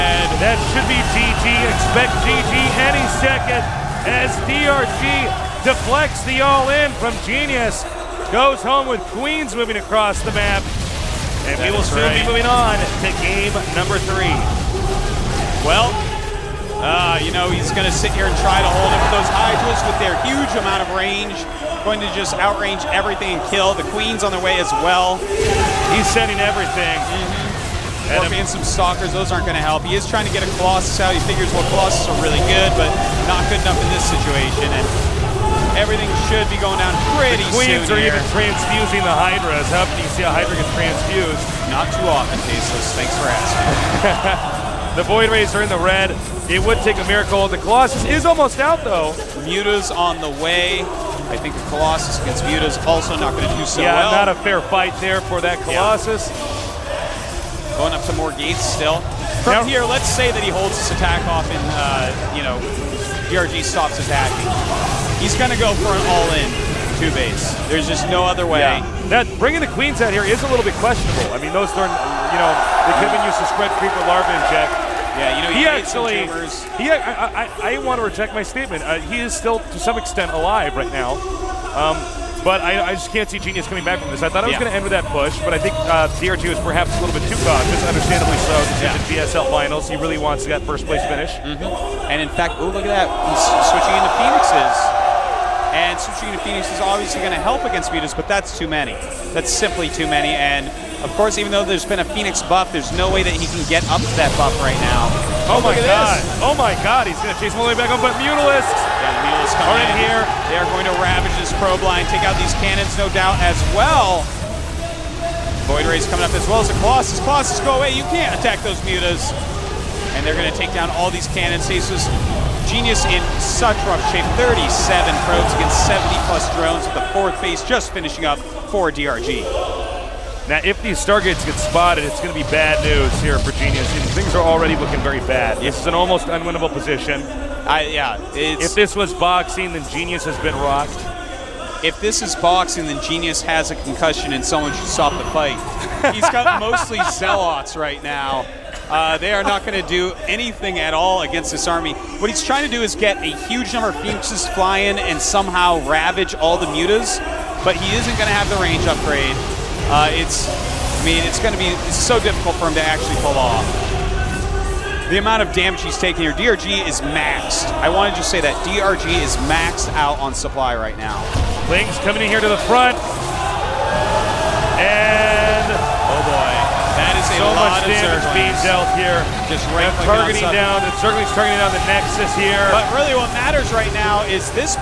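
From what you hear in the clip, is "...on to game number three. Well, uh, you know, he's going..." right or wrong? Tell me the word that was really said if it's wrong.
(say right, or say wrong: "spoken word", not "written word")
right.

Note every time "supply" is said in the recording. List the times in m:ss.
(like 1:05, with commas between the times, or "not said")
2:50.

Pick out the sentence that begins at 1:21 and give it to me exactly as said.
Um, but I, I, just can't see Genius coming back from this.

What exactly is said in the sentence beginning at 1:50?
They are going to ravage this probe line, take out these cannons, no doubt, as well.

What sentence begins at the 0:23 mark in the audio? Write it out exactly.
The Queen's on their way as well.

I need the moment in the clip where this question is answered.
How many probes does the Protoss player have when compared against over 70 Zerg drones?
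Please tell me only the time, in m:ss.
2:04.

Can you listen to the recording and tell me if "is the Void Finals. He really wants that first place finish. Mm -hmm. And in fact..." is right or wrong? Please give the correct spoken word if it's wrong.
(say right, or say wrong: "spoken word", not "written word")
wrong: "GSL", not "Void".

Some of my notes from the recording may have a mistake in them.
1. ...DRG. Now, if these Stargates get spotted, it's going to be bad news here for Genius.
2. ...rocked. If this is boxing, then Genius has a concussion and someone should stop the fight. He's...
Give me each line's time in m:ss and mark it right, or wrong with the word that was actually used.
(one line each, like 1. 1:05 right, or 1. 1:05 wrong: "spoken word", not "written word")
1. 2:08 right
2. 2:20 right.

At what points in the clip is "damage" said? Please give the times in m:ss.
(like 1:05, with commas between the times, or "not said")
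2:45, 2:57.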